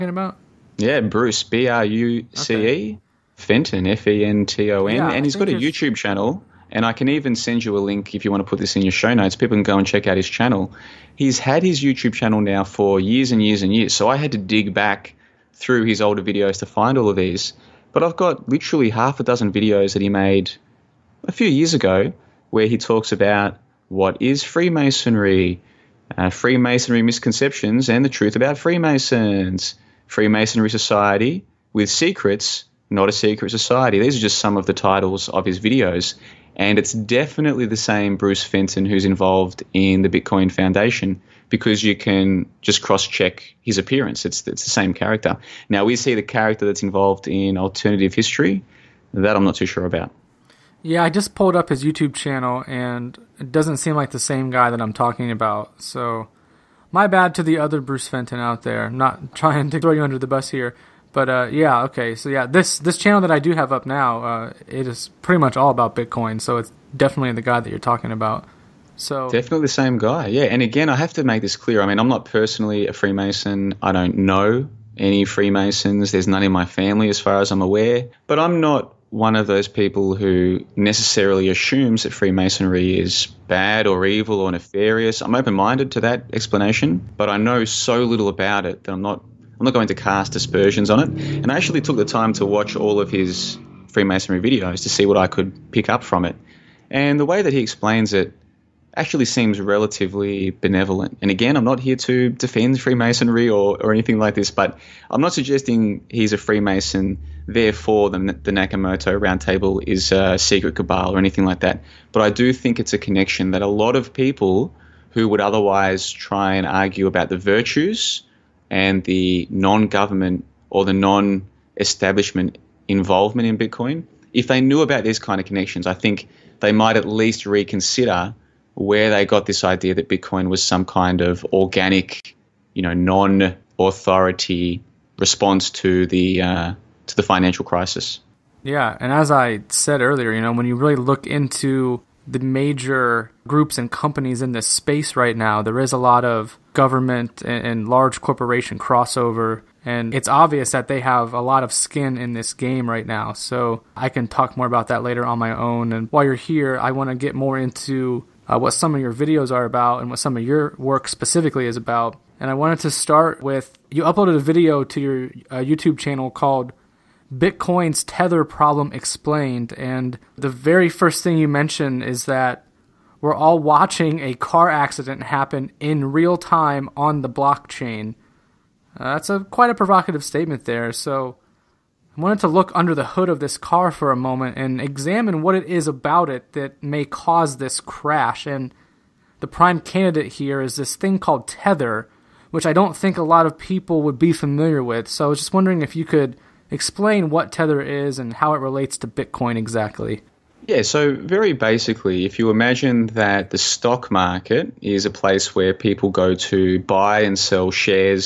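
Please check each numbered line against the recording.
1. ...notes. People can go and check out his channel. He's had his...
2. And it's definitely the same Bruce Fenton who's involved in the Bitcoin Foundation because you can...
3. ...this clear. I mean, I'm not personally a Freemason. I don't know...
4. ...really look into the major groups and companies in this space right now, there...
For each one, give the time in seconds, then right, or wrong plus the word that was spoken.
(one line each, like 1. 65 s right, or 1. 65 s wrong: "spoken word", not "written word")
1. 9 s right
2. 36 s right
3. 71 s right
4. 140 s right.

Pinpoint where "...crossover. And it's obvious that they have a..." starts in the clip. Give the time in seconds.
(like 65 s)
148 s.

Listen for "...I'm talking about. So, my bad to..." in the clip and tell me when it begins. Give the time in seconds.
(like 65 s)
54 s.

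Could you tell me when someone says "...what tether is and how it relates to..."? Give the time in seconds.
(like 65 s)
197 s.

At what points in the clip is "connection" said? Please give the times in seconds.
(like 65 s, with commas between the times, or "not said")
112 s, 125 s.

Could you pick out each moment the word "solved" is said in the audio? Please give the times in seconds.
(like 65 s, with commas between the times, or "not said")
not said.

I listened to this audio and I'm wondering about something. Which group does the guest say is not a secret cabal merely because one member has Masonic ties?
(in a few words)
Nakamoto Roundtable.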